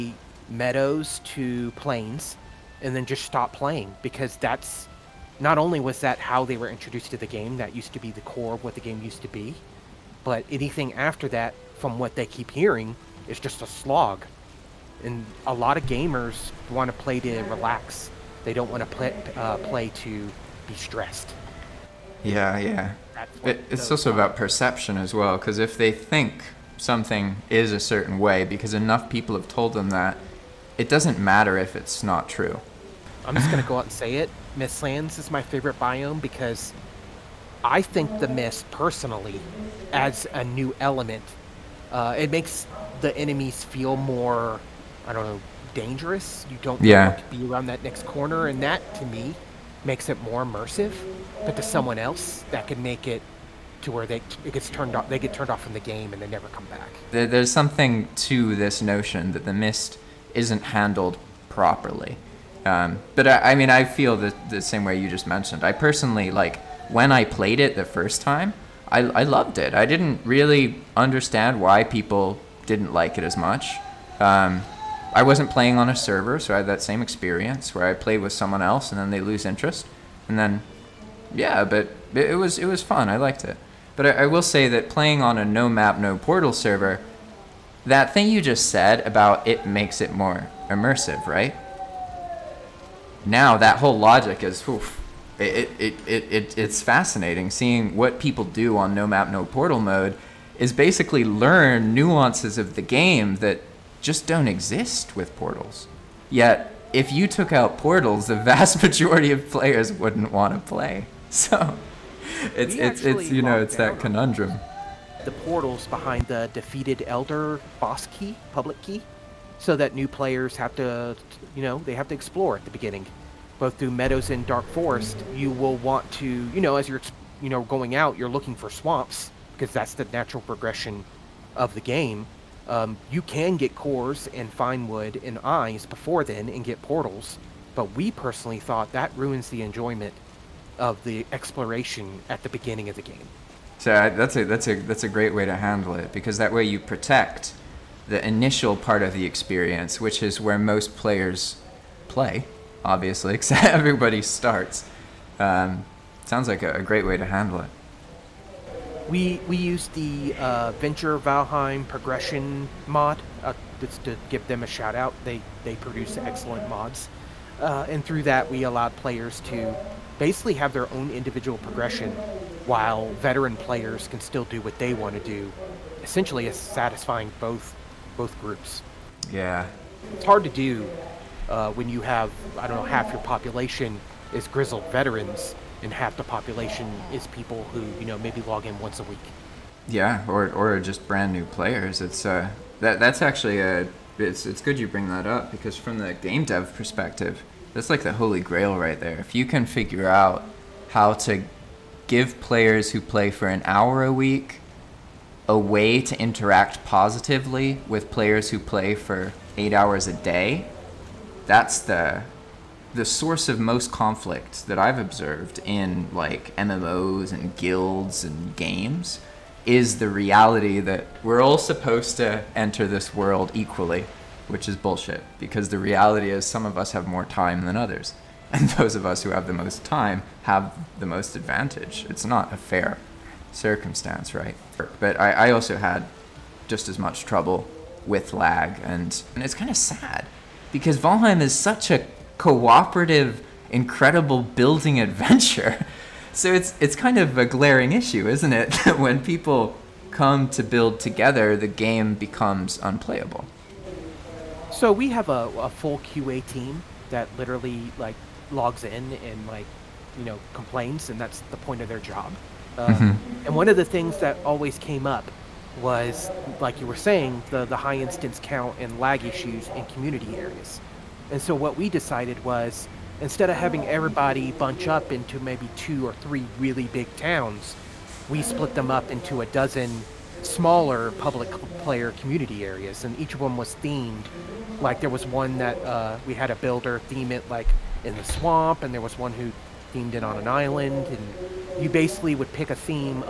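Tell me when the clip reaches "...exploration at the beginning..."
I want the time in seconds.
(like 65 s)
141 s.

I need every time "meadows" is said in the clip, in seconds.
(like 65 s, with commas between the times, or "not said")
0 s, 123 s.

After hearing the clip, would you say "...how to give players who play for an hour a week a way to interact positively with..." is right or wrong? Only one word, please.
right.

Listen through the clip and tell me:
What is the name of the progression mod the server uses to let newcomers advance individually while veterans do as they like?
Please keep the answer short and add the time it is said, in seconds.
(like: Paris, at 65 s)
Venture Valheim progression mod, at 160 s.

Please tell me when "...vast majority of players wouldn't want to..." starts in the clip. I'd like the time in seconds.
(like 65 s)
108 s.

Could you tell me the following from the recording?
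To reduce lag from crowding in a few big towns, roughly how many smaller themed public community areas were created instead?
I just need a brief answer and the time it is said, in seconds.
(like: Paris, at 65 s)
12, at 279 s.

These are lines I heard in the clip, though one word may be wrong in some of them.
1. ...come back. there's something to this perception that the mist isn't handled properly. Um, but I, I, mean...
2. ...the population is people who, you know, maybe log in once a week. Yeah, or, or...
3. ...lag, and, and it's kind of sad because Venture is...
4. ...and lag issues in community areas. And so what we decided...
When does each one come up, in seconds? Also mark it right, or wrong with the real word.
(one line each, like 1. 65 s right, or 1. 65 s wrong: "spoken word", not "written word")
1. 56 s wrong: "notion", not "perception"
2. 186 s right
3. 238 s wrong: "Valheim", not "Venture"
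4. 268 s right.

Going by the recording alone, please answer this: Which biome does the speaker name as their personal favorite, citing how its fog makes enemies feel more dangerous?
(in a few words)
Mistlands.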